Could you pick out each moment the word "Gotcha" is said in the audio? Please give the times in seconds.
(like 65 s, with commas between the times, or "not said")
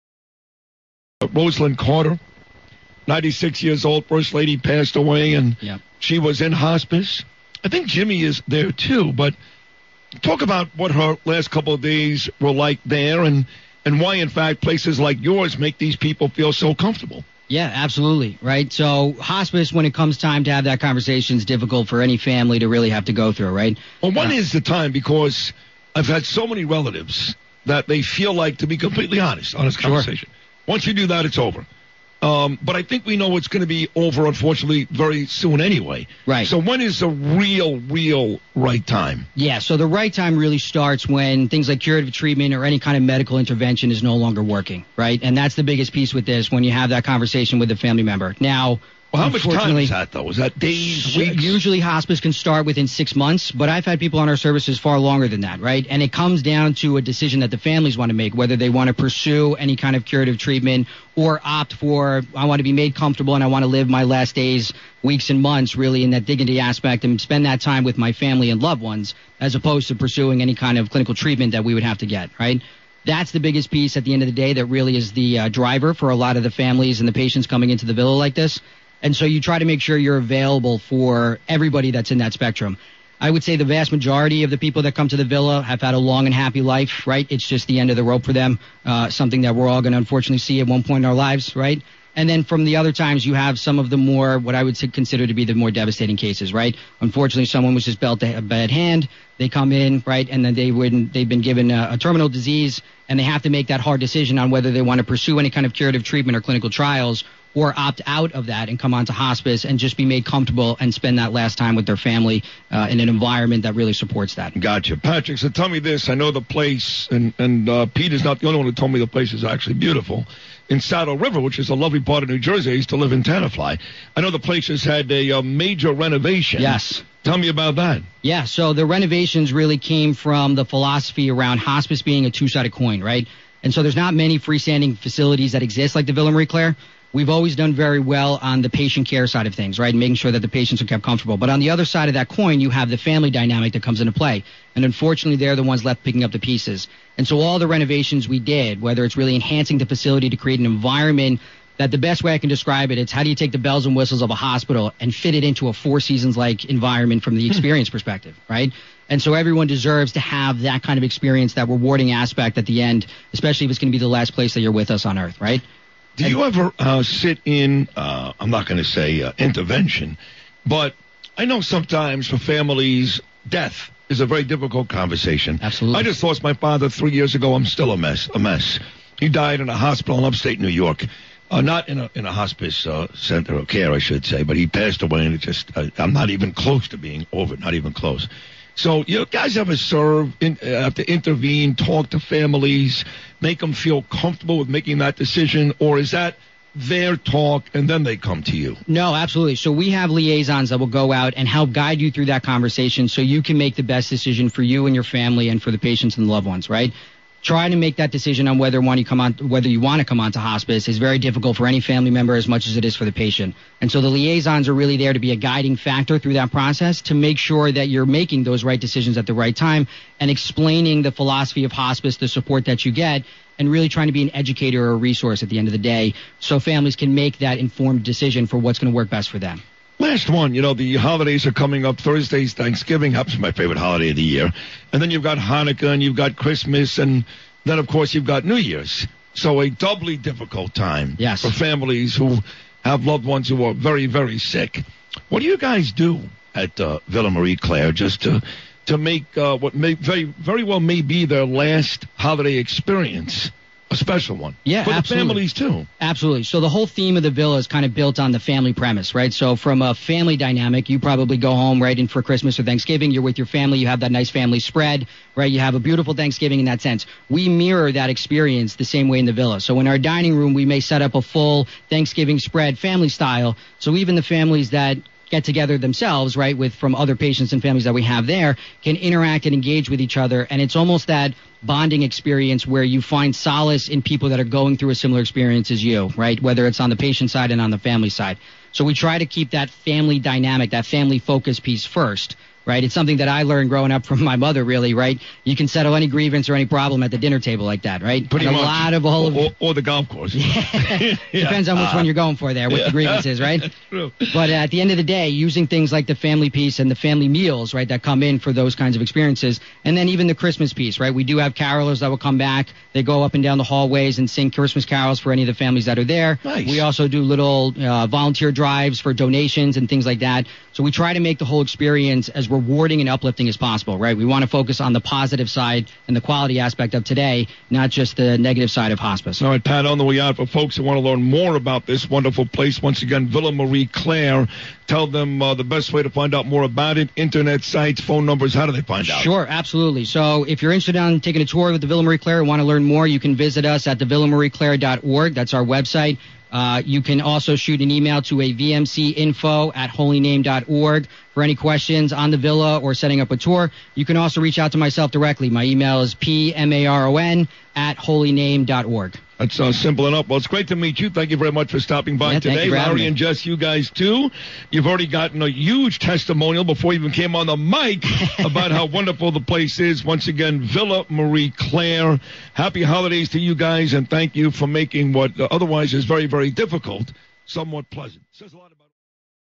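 114 s.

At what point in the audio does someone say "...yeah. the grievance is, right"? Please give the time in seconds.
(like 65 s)
302 s.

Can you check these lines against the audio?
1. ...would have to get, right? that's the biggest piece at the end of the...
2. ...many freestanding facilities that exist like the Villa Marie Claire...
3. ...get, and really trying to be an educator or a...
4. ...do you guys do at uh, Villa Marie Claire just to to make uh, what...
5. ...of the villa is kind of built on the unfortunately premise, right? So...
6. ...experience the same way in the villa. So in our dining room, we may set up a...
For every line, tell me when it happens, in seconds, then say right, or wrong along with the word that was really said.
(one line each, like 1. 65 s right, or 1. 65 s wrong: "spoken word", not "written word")
1. 71 s right
2. 134 s right
3. 222 s right
4. 245 s right
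5. 257 s wrong: "family", not "unfortunately"
6. 268 s right.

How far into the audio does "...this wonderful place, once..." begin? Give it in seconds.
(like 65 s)
331 s.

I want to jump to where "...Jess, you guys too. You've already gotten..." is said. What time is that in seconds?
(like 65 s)
363 s.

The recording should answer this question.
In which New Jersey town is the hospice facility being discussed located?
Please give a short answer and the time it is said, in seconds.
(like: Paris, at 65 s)
Saddle River, at 120 s.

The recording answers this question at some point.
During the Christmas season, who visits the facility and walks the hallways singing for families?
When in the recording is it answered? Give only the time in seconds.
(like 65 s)
311 s.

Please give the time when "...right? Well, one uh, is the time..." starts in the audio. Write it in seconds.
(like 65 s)
23 s.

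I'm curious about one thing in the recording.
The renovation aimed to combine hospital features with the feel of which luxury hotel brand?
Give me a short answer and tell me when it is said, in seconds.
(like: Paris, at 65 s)
Four Seasons, at 155 s.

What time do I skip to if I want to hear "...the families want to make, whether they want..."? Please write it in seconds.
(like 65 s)
57 s.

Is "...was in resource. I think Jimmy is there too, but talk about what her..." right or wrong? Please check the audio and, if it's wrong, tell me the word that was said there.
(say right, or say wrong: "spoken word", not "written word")
wrong: "hospice", not "resource".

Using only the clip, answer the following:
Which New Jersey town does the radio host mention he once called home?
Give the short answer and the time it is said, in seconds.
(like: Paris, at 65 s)
Tenafly, at 123 s.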